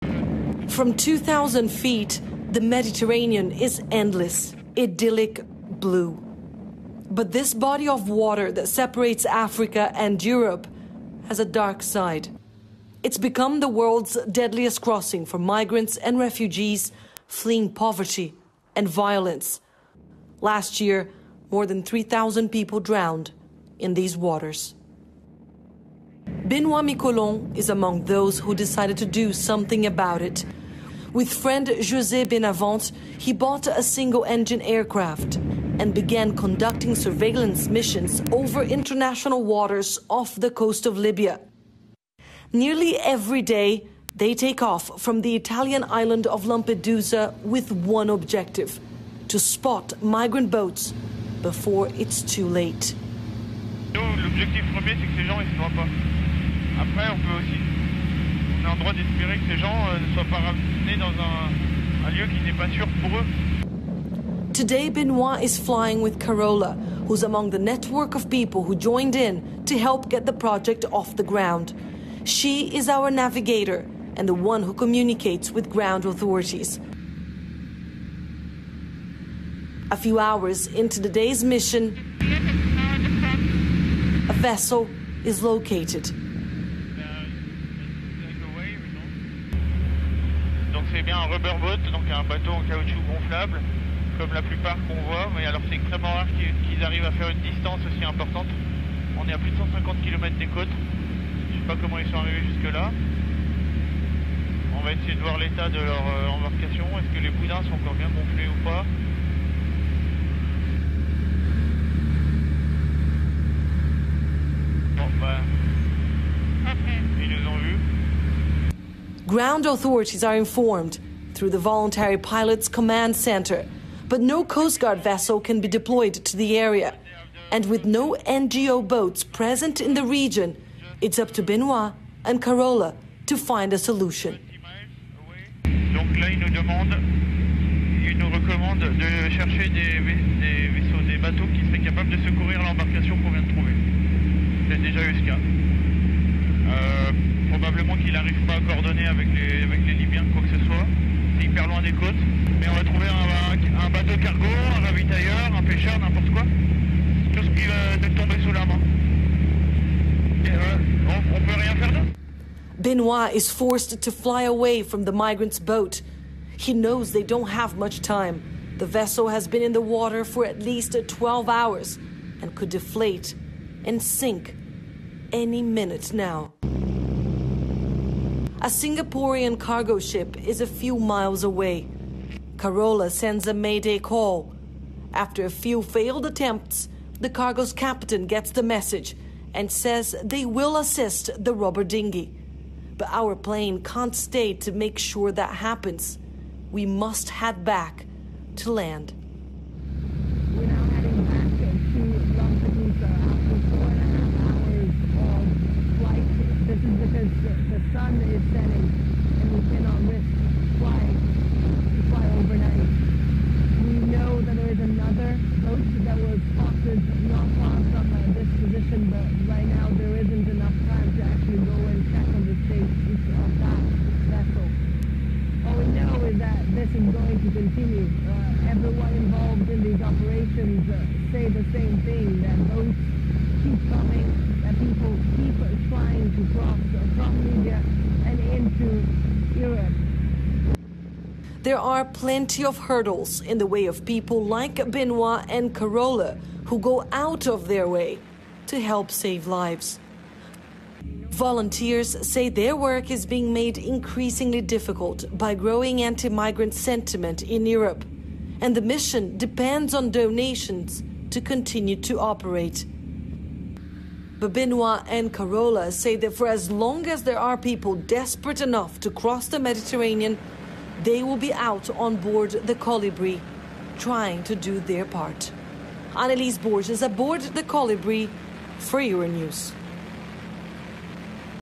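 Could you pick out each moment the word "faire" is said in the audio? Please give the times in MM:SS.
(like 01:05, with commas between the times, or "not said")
01:37, 02:41.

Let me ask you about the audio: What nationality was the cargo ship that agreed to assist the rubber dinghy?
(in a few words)
Singaporean.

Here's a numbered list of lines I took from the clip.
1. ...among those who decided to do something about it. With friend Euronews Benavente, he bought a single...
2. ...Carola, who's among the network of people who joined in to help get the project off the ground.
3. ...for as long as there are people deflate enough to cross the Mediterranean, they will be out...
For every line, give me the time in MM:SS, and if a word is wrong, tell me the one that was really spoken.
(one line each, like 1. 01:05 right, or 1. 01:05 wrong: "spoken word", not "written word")
1. 00:27 wrong: "José", not "Euronews"
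2. 01:06 right
3. 04:26 wrong: "desperate", not "deflate".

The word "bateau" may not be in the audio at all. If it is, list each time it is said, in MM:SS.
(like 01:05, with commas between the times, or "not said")
01:32, 02:33.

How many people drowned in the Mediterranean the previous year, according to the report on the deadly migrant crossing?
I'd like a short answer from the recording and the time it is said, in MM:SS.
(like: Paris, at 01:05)
more than 3,000, at 00:21.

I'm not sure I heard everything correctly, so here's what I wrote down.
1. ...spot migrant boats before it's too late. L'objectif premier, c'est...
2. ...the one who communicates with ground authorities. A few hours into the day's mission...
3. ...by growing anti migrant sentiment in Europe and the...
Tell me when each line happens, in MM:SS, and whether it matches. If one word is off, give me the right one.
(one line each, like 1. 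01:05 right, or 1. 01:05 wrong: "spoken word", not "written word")
1. 00:49 right
2. 01:14 right
3. 04:15 right.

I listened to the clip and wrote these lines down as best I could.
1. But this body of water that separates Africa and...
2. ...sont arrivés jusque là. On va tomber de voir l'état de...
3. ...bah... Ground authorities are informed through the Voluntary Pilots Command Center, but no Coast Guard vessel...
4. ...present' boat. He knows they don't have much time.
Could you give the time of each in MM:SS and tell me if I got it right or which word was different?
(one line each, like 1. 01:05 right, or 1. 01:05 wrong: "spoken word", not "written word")
1. 00:07 right
2. 01:42 wrong: "essayer", not "tomber"
3. 01:55 right
4. 02:45 wrong: "migrants", not "present".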